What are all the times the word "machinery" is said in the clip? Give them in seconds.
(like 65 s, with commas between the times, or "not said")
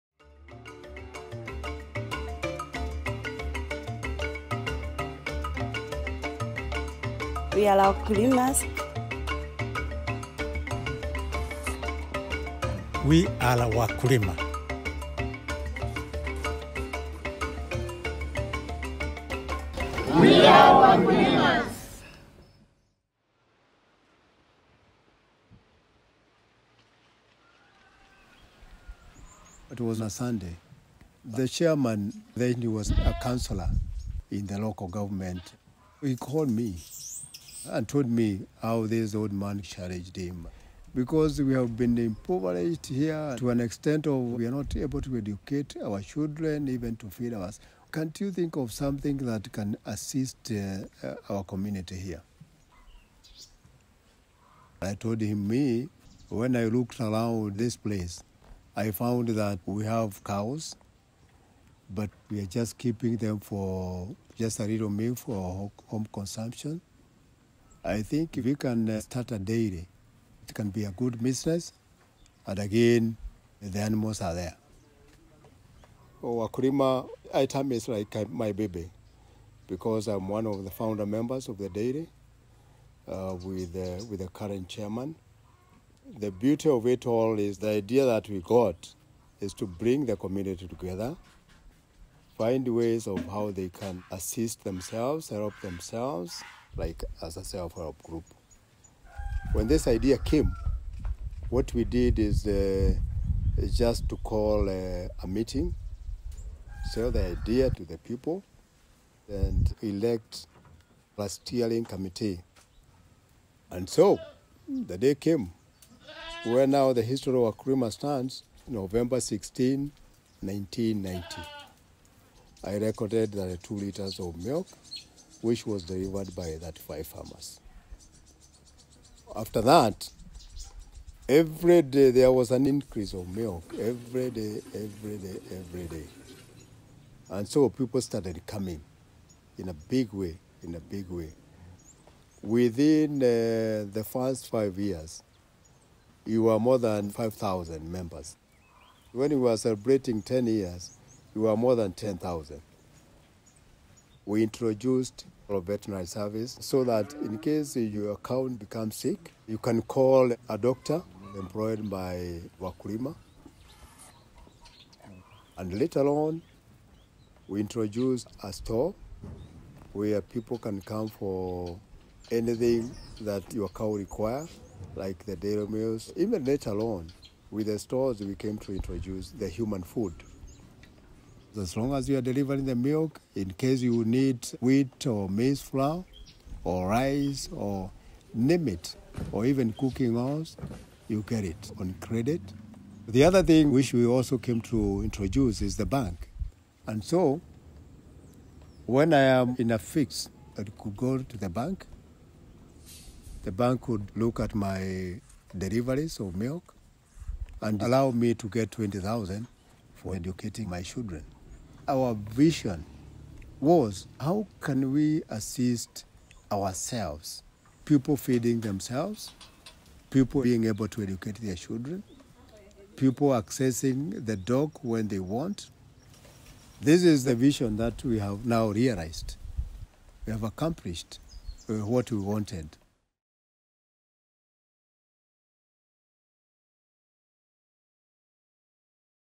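not said.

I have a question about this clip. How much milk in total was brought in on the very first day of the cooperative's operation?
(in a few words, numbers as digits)
2 liters.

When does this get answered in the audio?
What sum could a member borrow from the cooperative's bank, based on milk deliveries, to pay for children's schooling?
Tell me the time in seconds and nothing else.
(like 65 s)
208 s.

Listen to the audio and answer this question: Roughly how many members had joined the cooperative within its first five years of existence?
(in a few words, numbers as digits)
5,000.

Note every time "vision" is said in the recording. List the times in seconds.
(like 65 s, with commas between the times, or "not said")
212 s, 227 s.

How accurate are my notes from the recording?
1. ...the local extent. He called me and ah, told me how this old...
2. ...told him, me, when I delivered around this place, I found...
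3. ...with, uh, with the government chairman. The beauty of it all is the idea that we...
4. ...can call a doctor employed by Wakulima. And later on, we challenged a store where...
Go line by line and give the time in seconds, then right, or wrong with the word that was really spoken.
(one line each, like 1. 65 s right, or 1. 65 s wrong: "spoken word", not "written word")
1. 34 s wrong: "government", not "extent"
2. 54 s wrong: "looked", not "delivered"
3. 83 s wrong: "current", not "government"
4. 159 s wrong: "introduced", not "challenged".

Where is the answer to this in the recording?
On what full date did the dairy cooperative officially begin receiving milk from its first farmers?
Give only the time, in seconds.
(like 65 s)
118 s.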